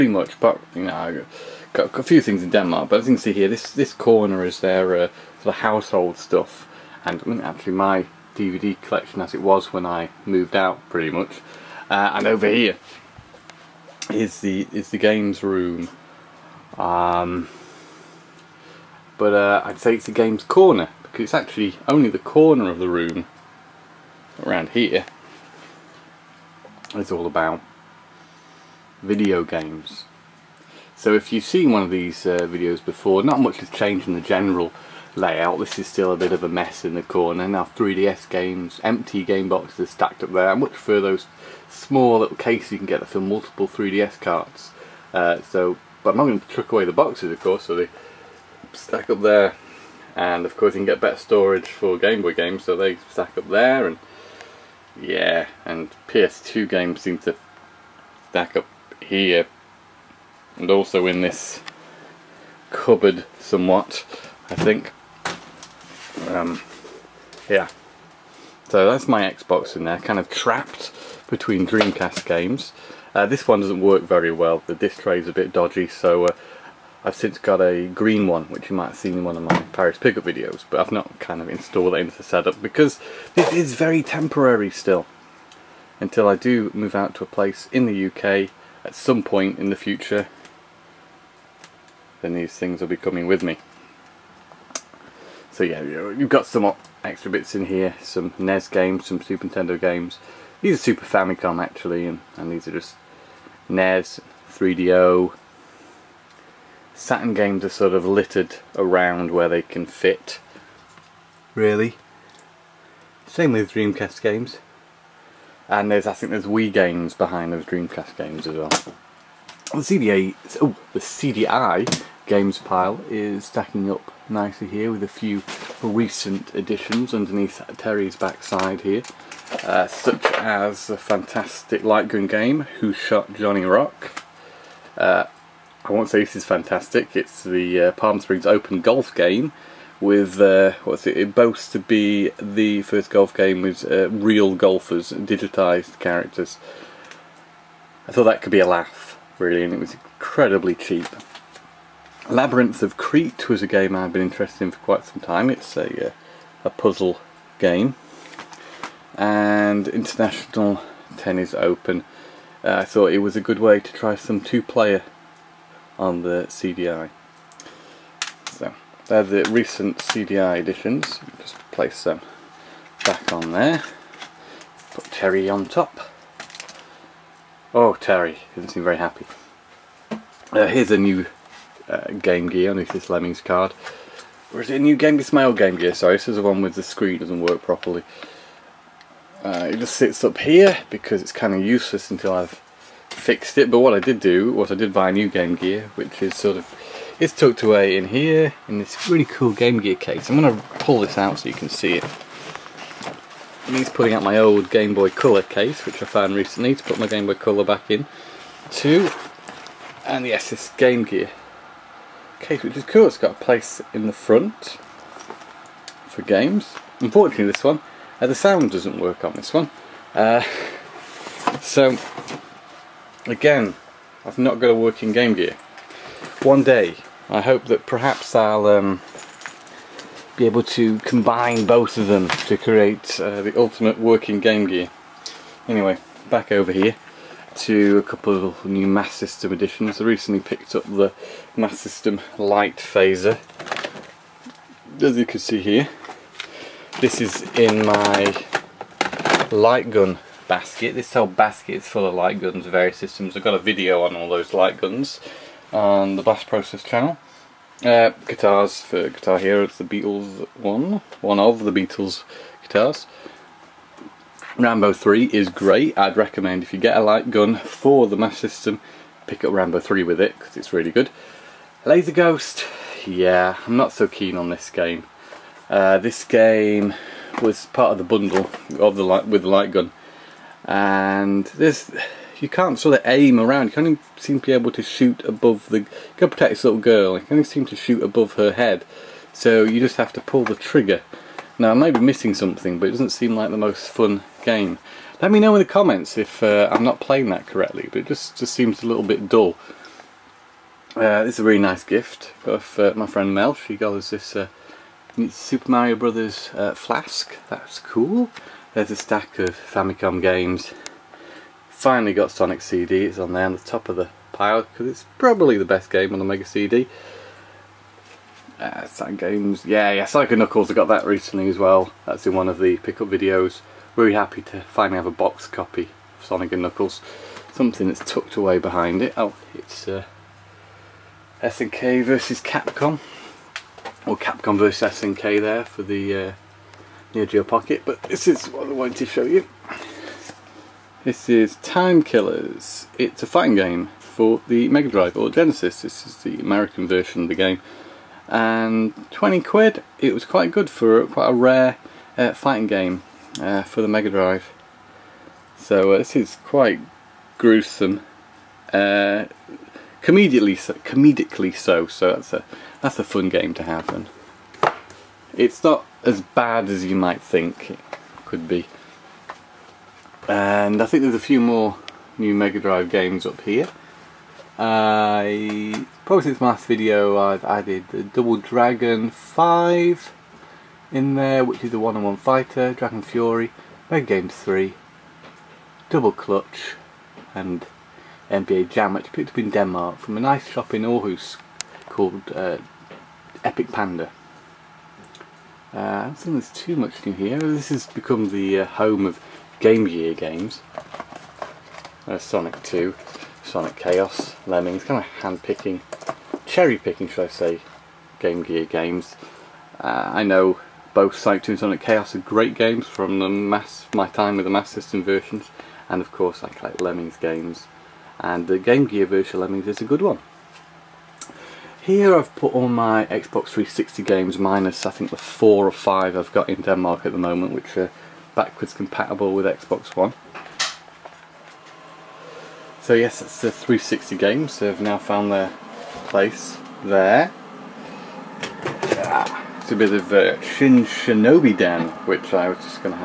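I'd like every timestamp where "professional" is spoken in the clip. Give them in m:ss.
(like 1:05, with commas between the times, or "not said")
not said.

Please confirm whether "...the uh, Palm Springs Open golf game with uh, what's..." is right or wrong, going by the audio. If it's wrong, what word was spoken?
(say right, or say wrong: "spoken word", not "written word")
right.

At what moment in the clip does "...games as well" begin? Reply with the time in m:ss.
1:58.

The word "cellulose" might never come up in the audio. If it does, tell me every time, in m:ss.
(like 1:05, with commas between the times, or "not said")
not said.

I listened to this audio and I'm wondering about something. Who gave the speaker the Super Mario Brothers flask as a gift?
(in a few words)
Mel.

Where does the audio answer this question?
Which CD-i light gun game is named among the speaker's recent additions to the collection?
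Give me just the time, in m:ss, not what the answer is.
2:12.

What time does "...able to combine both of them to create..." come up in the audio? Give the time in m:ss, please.
3:50.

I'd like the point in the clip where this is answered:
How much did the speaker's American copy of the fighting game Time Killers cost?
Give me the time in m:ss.
5:49.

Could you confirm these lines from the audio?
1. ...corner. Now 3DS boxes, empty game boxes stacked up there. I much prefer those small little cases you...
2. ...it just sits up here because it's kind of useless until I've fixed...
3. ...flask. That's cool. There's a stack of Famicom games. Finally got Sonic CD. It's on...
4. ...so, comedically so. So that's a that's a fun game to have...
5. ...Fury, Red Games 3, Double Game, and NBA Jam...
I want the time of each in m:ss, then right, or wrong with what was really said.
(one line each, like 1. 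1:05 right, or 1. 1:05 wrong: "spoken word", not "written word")
1. 0:37 wrong: "games", not "boxes"
2. 3:09 right
3. 5:06 right
4. 6:00 right
5. 6:23 wrong: "Clutch", not "Game".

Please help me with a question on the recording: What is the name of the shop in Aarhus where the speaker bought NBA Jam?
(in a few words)
Epic Panda.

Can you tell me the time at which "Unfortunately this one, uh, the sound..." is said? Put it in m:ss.
3:36.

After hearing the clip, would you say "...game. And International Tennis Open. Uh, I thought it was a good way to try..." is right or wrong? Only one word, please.
right.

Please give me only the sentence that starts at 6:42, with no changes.
Uh, Sonic 2, Sonic Chaos, Lemmings, kind of hand-picking, cherry-picking should I say, Game Gear games.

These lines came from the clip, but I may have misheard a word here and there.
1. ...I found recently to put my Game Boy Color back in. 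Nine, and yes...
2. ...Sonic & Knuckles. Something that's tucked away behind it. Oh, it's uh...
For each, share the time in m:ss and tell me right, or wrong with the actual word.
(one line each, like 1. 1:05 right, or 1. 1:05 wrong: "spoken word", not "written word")
1. 3:26 wrong: "Two", not "Nine"
2. 5:26 right.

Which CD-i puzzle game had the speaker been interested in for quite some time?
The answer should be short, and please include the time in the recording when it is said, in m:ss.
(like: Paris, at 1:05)
Labyrinth of Crete, at 2:32.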